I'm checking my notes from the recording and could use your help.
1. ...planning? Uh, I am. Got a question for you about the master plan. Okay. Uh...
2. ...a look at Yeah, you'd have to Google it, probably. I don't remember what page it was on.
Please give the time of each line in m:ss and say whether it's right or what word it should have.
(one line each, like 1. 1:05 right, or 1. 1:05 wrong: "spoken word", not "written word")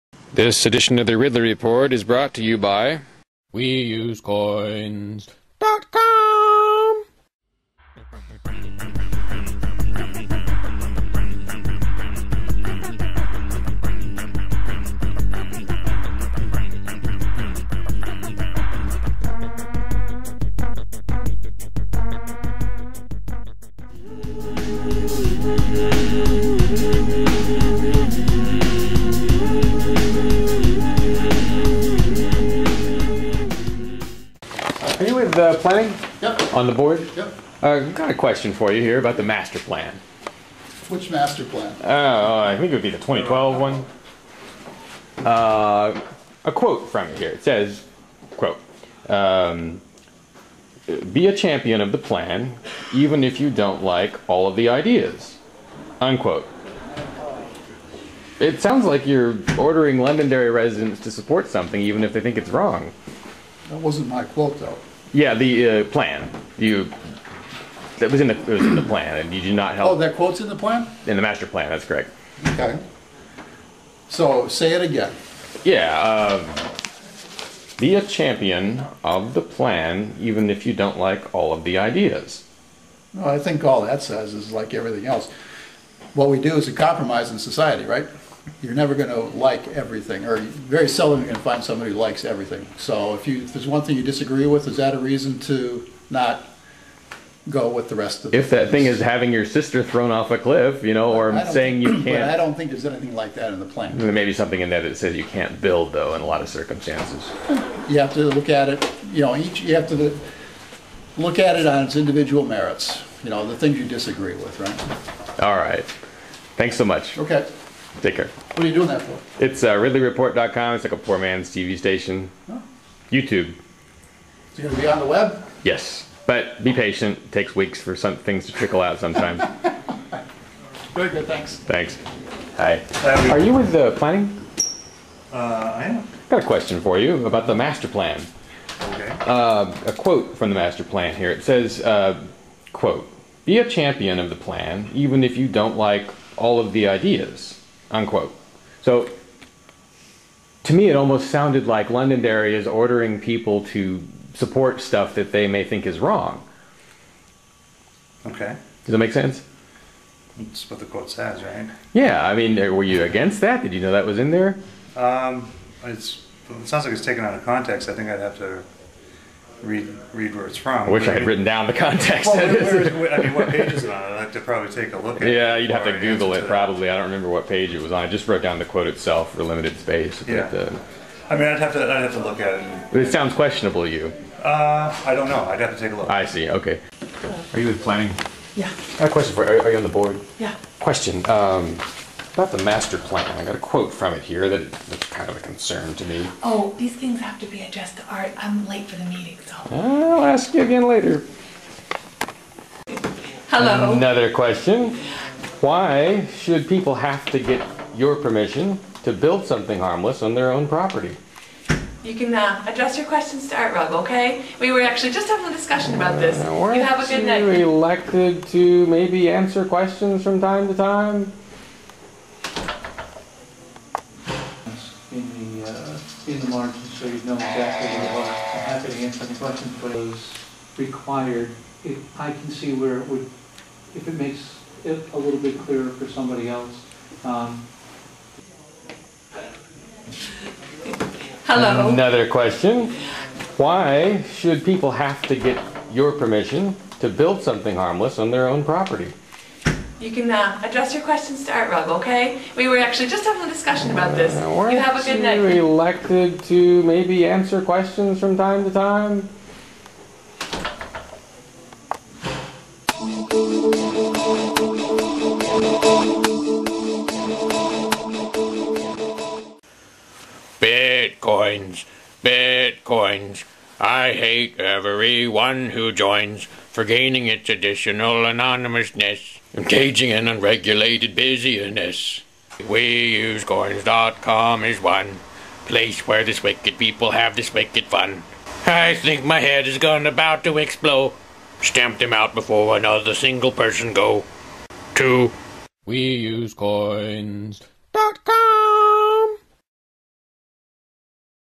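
1. 2:13 right
2. 2:54 right.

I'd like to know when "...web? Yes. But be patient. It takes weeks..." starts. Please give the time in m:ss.
2:05.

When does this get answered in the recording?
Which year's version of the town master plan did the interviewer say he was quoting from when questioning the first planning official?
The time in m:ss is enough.
0:42.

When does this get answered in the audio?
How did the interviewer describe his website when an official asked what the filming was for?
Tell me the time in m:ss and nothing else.
2:00.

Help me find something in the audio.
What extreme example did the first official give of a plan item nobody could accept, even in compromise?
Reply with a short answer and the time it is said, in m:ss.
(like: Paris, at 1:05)
Sister thrown off a cliff, at 1:39.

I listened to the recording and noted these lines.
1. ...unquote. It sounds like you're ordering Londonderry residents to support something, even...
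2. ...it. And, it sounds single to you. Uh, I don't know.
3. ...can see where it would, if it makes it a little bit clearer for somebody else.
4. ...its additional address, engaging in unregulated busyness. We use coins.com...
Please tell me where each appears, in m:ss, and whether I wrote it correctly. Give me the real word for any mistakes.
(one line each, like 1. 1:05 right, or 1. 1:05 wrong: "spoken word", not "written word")
1. 0:56 right
2. 3:02 wrong: "questionable", not "single"
3. 3:52 right
4. 4:37 wrong: "anonymousness", not "address".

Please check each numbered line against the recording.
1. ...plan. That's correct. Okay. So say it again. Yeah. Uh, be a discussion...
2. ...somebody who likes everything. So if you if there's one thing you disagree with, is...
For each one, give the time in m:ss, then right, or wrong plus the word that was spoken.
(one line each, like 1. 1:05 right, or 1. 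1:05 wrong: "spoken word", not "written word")
1. 1:11 wrong: "champion", not "discussion"
2. 1:31 right.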